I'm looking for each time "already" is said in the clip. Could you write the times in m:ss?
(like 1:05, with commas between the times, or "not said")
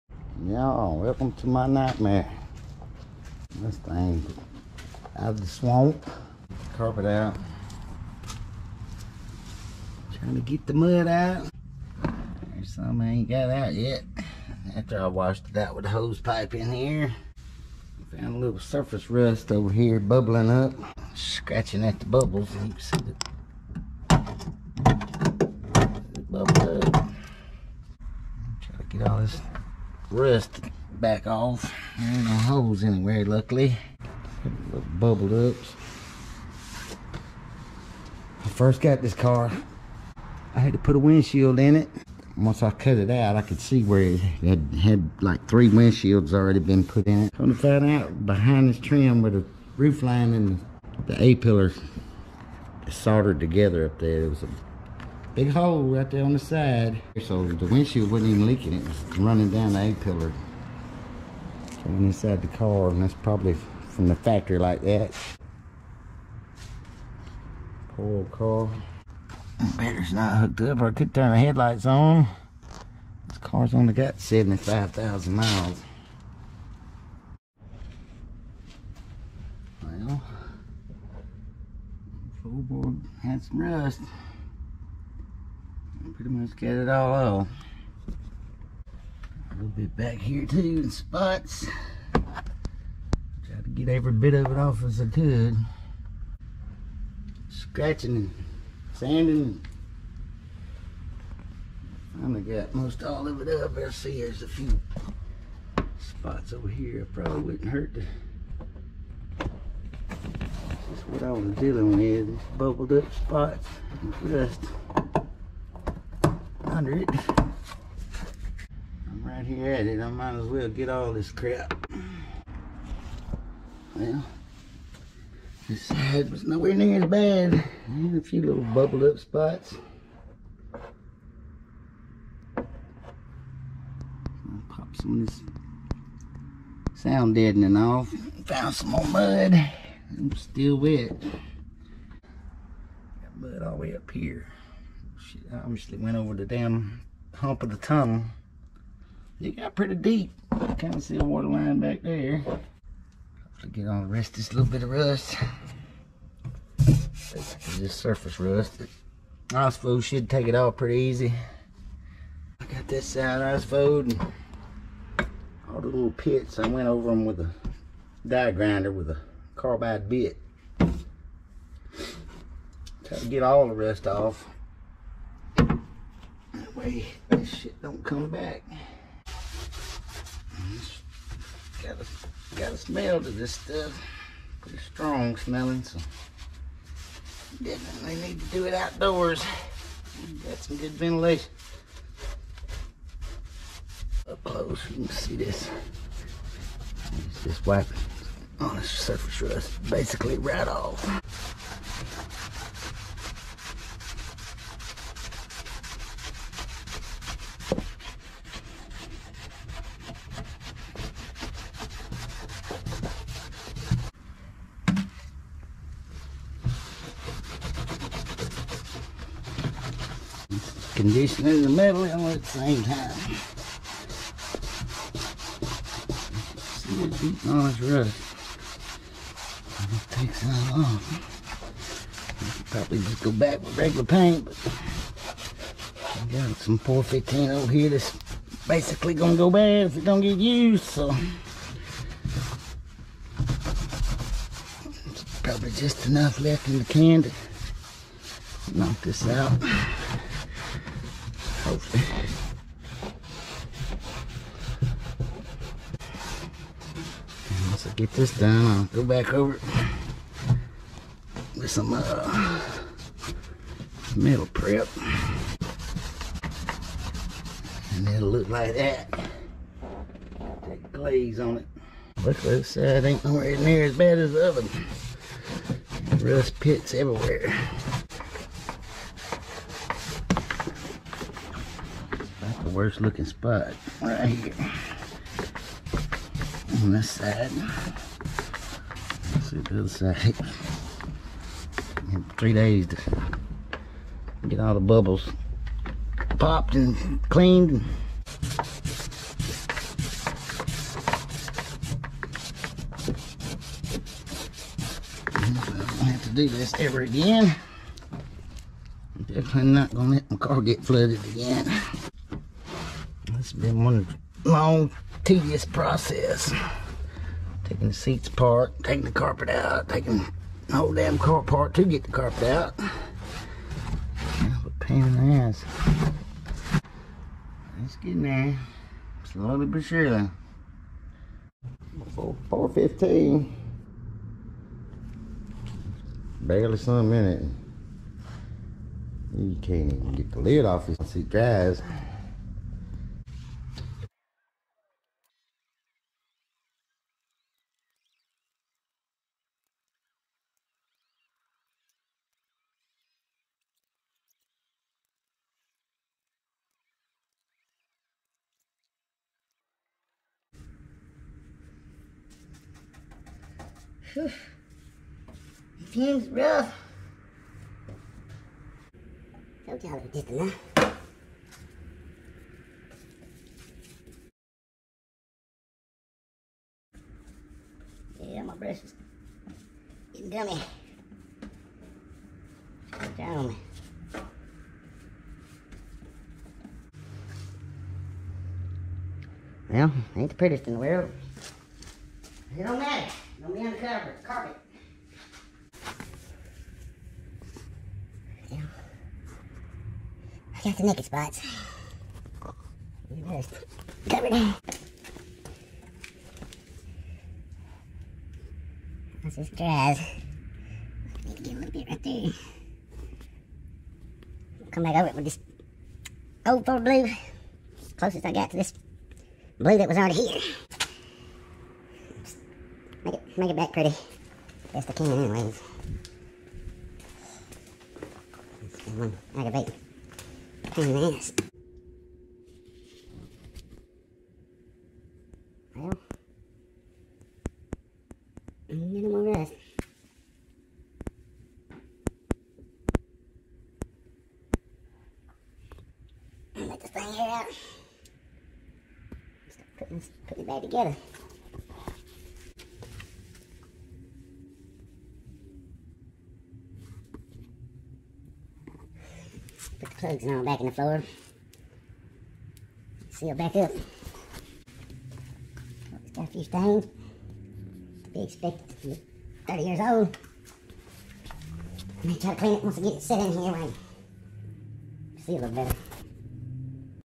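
0:46, 6:59.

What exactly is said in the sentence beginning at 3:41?
condition in the middle and at the same time.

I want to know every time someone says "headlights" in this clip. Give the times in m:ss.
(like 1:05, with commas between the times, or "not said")
1:11.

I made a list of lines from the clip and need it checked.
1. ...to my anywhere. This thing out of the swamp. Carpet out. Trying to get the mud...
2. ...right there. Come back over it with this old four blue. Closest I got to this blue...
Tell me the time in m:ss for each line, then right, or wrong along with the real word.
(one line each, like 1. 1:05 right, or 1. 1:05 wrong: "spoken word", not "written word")
1. 0:01 wrong: "nightmare", not "anywhere"
2. 6:51 right.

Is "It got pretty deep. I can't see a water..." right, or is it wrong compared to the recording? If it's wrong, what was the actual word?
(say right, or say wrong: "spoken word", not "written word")
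right.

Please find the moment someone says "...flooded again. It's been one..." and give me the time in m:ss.
5:10.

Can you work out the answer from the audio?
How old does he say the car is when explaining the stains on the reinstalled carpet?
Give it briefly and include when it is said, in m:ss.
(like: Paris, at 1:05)
30 years, at 7:49.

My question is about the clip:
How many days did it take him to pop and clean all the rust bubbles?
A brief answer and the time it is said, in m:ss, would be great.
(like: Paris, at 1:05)
3, at 4:52.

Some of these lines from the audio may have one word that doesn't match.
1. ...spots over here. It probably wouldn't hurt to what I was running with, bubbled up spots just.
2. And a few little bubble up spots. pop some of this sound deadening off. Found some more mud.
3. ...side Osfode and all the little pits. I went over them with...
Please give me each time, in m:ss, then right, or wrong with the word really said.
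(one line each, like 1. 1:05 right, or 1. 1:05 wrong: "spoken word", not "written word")
1. 1:45 wrong: "dealing", not "running"
2. 2:07 right
3. 2:43 right.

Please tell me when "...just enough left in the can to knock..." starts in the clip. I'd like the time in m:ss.
4:05.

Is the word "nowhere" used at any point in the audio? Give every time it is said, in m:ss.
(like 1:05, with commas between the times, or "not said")
2:06, 4:33.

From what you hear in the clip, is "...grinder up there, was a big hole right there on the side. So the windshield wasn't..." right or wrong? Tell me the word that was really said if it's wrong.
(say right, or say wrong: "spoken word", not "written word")
wrong: "together", not "grinder".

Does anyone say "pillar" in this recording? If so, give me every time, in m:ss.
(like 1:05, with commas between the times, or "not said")
0:51, 0:59.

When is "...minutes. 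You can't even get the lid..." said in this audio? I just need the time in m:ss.
5:37.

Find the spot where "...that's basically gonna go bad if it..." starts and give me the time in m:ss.
3:57.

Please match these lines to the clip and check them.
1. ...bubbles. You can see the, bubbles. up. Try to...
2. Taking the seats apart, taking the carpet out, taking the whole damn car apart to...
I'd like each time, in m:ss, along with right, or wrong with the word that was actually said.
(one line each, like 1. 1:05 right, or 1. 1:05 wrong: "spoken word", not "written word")
1. 0:22 right
2. 5:17 right.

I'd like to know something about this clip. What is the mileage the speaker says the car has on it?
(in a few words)
75,000 miles.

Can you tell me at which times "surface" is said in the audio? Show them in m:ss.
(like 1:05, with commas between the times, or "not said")
0:18, 2:37, 3:18.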